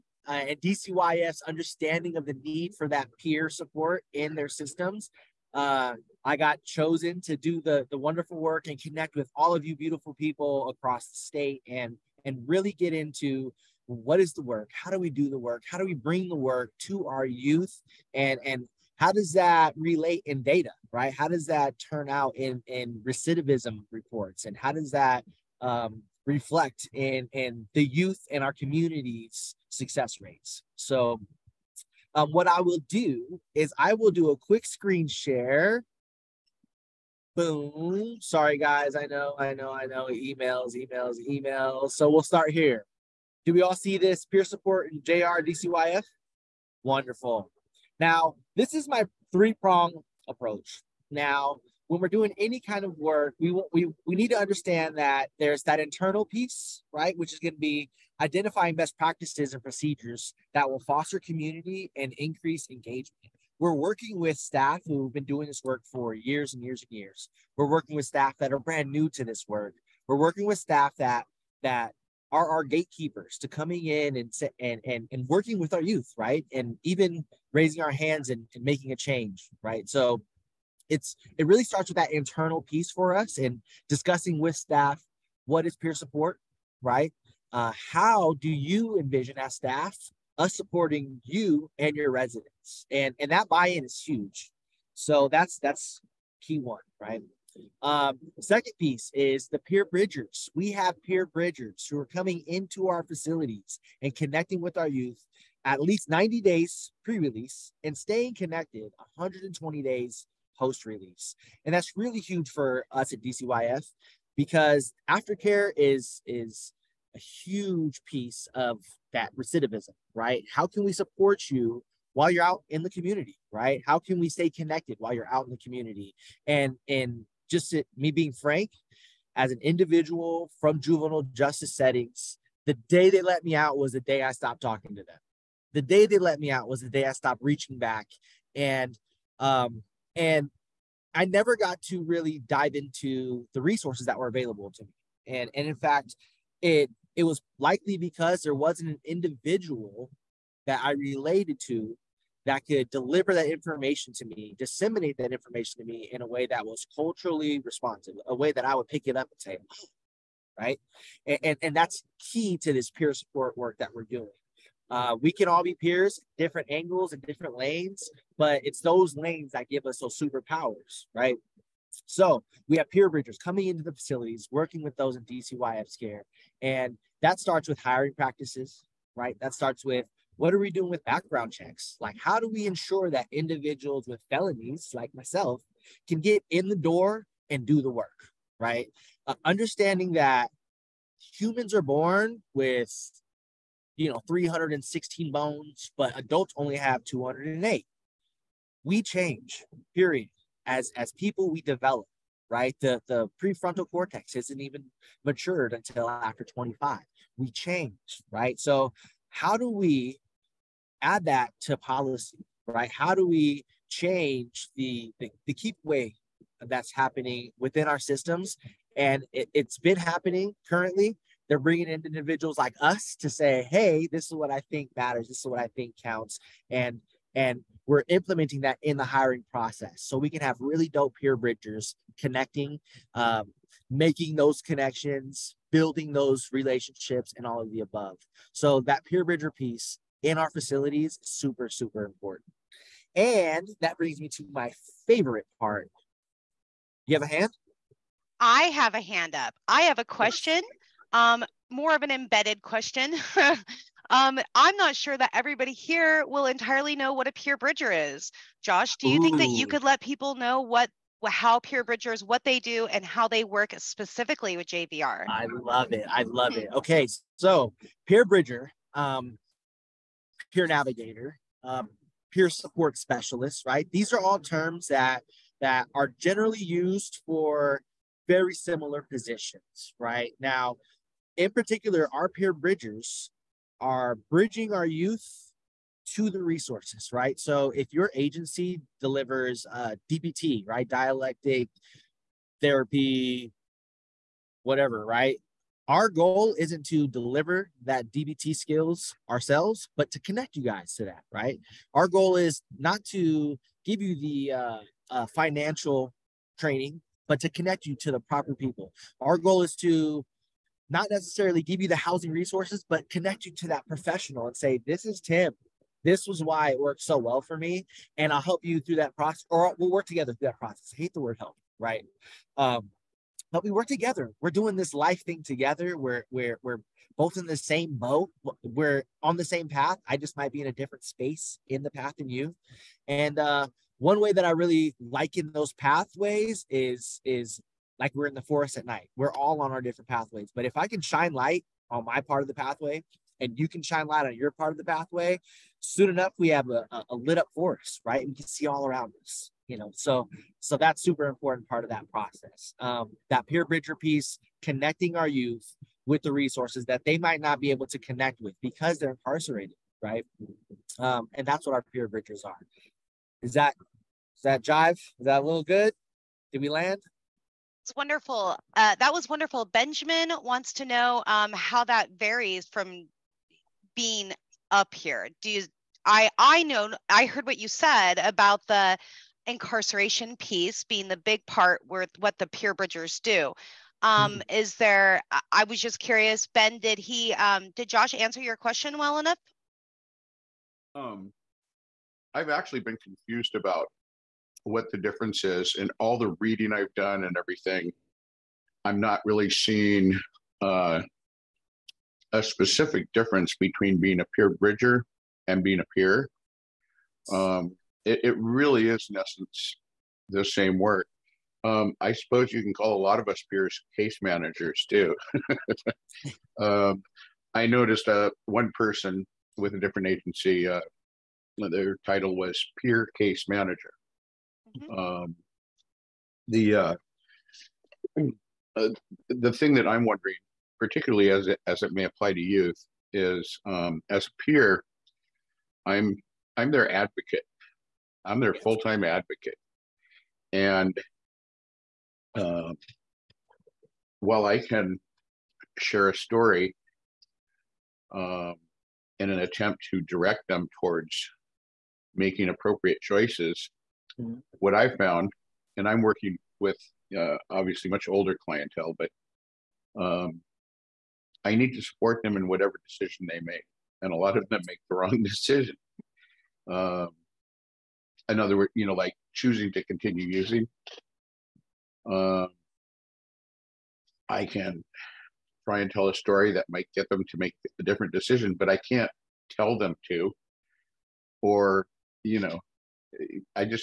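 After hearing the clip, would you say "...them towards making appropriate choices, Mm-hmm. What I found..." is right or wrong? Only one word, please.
right.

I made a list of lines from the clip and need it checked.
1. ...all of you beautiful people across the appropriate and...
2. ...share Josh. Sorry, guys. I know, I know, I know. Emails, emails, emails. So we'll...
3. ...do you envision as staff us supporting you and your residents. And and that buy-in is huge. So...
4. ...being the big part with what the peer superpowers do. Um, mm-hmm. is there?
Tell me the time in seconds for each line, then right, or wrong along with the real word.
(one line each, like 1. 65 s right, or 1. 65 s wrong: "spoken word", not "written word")
1. 9 s wrong: "state", not "appropriate"
2. 35 s wrong: "Boom", not "Josh"
3. 88 s right
4. 380 s wrong: "bridgers", not "superpowers".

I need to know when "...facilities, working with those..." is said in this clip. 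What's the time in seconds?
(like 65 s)
173 s.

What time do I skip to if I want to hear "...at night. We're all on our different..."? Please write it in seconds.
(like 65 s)
338 s.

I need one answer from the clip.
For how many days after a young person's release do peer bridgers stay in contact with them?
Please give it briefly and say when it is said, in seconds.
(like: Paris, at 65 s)
120, at 109 s.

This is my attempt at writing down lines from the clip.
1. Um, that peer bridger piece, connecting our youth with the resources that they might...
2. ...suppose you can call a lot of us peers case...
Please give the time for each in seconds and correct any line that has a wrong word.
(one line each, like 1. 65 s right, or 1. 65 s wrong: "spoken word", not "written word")
1. 352 s right
2. 412 s right.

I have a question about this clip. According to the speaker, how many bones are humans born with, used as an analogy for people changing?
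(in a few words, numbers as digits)
316.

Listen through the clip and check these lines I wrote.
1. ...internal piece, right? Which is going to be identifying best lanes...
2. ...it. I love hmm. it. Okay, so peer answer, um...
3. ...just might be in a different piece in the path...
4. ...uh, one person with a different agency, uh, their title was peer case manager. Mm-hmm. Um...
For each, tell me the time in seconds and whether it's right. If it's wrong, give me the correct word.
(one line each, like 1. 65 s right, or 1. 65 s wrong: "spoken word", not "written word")
1. 55 s wrong: "practices", not "lanes"
2. 265 s wrong: "bridger", not "answer"
3. 330 s wrong: "space", not "piece"
4. 418 s right.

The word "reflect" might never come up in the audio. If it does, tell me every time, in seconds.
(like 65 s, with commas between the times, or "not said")
26 s.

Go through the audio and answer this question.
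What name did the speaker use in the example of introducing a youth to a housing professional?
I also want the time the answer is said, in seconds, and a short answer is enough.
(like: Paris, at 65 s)
Tim, at 315 s.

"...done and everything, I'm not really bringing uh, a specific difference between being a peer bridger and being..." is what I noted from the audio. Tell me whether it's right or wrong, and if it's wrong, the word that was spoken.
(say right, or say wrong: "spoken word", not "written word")
wrong: "seeing", not "bringing".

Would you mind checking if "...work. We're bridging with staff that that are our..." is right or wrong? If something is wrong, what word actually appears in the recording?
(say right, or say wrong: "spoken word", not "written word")
wrong: "working", not "bridging".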